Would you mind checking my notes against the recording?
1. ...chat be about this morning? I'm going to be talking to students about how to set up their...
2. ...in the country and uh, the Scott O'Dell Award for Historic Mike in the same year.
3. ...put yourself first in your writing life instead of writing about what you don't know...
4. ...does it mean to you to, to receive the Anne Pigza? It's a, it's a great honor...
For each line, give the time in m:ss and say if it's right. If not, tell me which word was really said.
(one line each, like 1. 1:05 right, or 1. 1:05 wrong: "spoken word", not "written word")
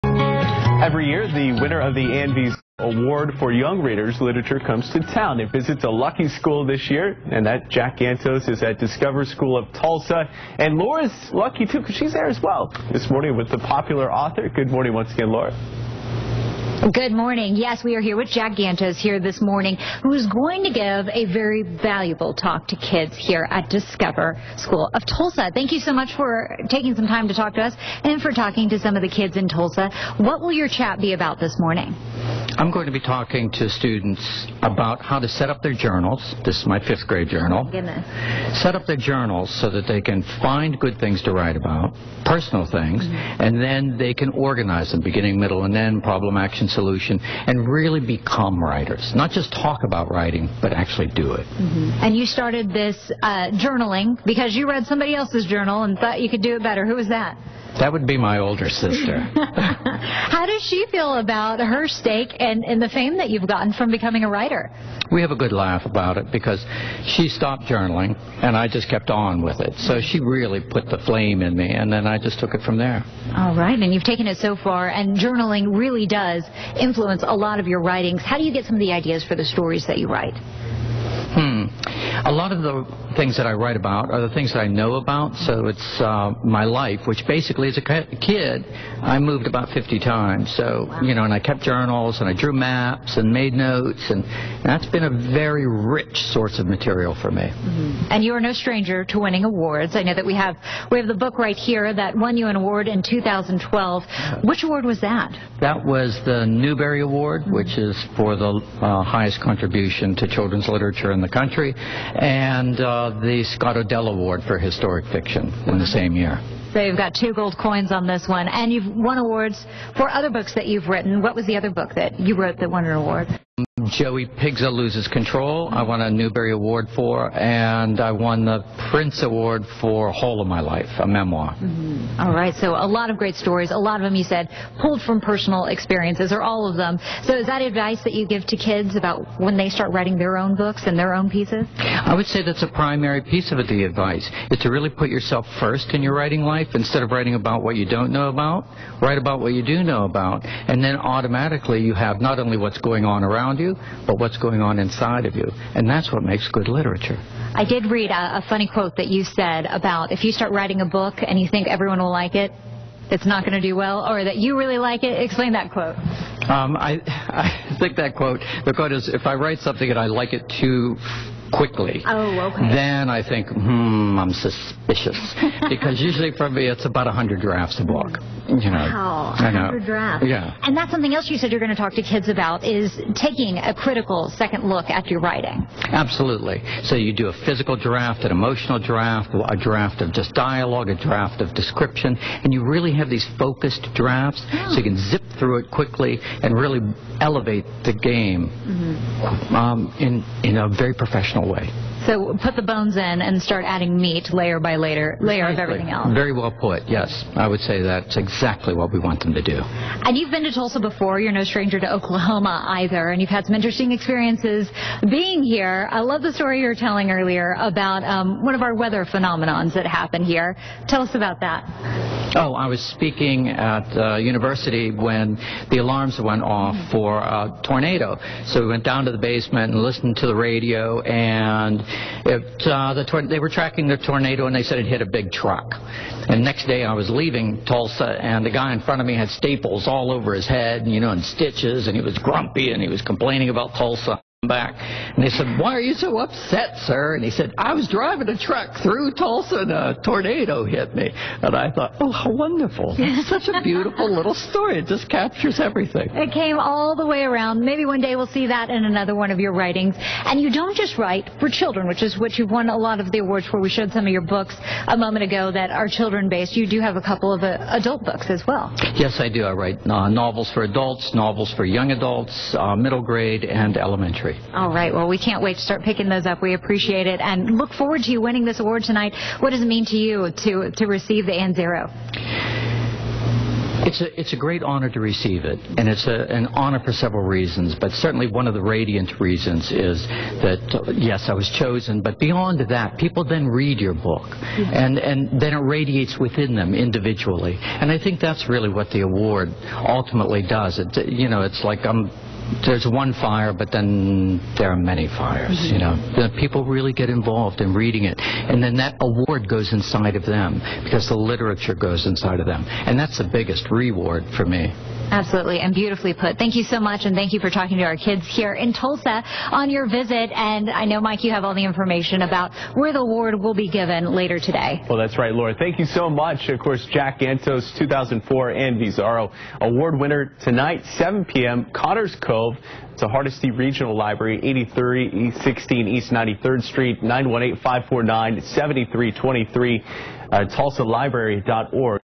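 1. 0:30 right
2. 1:51 wrong: "Fiction", not "Mike"
3. 2:24 right
4. 4:39 wrong: "Zarrow", not "Pigza".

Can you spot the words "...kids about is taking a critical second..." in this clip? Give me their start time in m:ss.
3:02.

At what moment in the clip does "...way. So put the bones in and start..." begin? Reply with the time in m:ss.
3:21.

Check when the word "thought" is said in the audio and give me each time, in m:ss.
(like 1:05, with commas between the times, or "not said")
0:55, 4:11.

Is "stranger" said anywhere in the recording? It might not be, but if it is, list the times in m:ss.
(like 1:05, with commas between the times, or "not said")
1:38, 3:31.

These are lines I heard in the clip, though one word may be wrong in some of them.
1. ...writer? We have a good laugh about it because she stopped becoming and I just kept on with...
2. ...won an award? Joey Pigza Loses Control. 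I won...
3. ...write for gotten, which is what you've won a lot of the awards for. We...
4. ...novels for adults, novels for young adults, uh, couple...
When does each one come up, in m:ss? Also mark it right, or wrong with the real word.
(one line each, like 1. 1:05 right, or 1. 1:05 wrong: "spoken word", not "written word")
1. 1:04 wrong: "journaling", not "becoming"
2. 2:02 right
3. 4:20 wrong: "children", not "gotten"
4. 4:30 wrong: "middle", not "couple".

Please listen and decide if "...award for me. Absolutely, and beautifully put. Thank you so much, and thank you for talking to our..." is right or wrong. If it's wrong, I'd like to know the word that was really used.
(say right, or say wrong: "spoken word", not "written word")
wrong: "reward", not "award".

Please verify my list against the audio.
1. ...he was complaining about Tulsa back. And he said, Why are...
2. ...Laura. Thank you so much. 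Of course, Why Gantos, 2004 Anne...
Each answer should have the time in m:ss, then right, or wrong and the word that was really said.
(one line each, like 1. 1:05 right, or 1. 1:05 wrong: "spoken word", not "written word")
1. 4:02 right
2. 5:25 wrong: "Jack", not "Why".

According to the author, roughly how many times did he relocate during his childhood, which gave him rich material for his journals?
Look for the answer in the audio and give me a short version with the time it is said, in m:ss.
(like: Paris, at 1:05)
50, at 1:29.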